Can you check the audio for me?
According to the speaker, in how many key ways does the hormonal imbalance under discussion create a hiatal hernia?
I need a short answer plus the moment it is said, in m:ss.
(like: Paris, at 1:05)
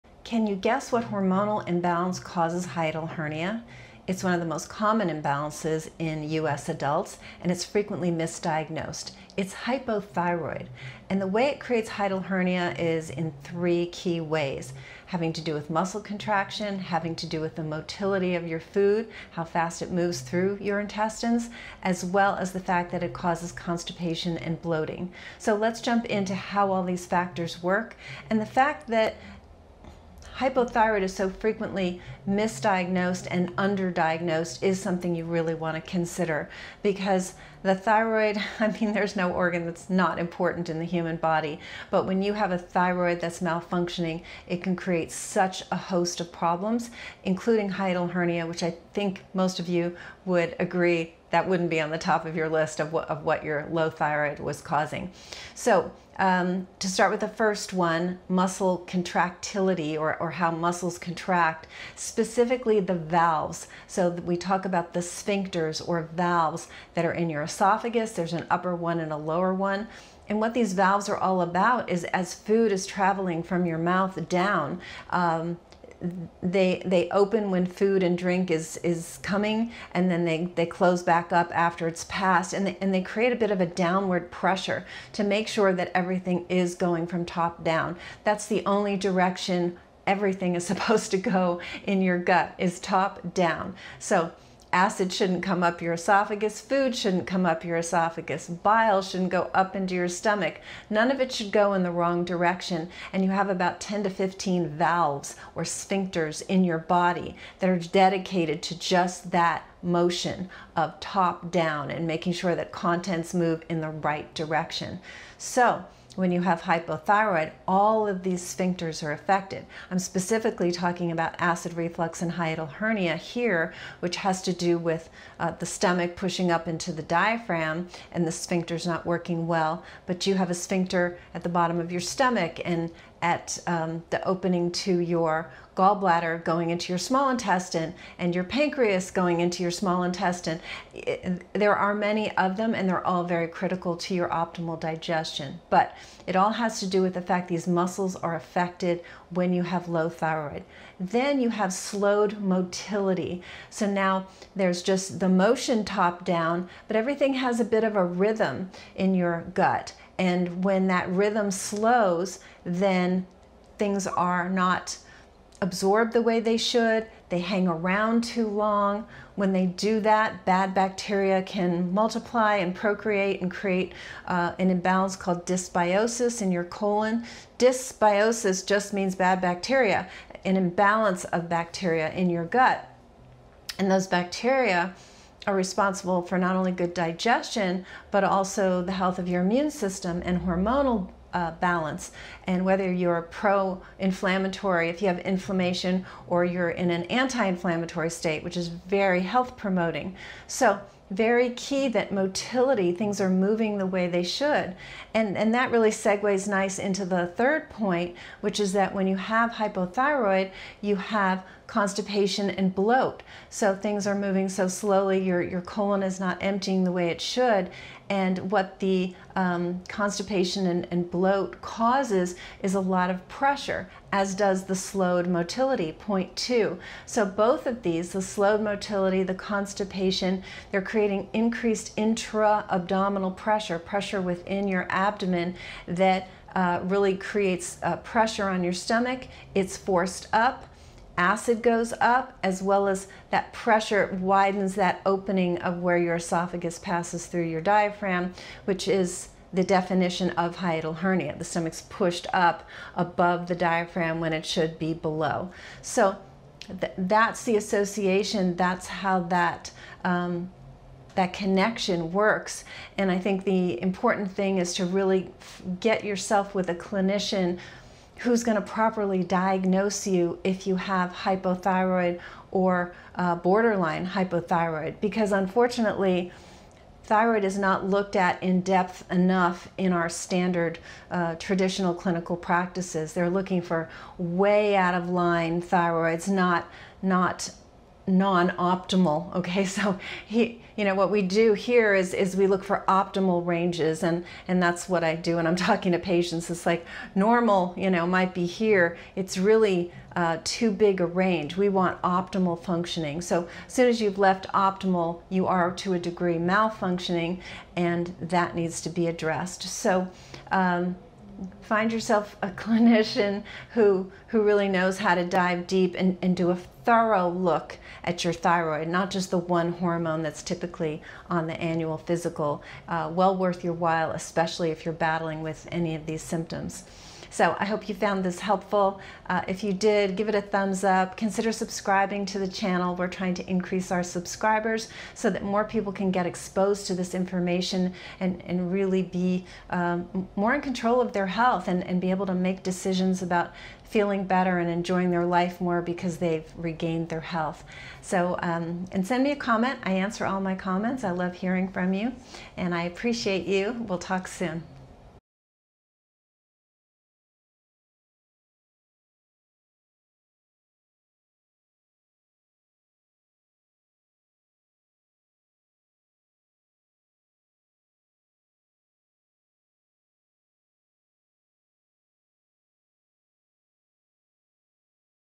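3, at 0:13.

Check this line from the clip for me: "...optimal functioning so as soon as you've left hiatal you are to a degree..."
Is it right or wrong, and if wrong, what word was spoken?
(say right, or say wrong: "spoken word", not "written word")
wrong: "optimal", not "hiatal".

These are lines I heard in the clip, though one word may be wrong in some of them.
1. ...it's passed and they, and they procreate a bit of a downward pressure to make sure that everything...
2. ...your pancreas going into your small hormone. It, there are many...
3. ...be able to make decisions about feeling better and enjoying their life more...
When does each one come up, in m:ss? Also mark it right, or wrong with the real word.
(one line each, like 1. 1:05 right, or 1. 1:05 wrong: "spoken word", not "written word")
1. 1:21 wrong: "create", not "procreate"
2. 2:18 wrong: "intestine", not "hormone"
3. 5:42 right.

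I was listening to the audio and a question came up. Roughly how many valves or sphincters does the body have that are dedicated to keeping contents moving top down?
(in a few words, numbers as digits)
10 to 15.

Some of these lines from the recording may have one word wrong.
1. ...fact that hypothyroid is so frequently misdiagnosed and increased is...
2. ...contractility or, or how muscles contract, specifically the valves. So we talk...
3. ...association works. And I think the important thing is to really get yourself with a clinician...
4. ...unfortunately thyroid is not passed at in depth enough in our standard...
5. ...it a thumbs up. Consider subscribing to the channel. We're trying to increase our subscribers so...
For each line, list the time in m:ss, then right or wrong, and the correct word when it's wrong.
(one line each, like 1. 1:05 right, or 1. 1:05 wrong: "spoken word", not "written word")
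1. 0:28 wrong: "underdiagnosed", not "increased"
2. 0:58 right
3. 4:21 wrong: "connection", not "association"
4. 4:35 wrong: "looked", not "passed"
5. 5:30 right.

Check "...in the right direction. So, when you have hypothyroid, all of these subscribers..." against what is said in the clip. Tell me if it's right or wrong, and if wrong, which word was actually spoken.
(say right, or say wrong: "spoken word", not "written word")
wrong: "sphincters", not "subscribers".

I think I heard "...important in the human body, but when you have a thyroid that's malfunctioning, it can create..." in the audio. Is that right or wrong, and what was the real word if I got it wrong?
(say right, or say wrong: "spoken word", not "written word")
right.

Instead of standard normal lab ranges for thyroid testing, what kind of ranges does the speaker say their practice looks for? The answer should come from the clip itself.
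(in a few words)
optimal ranges.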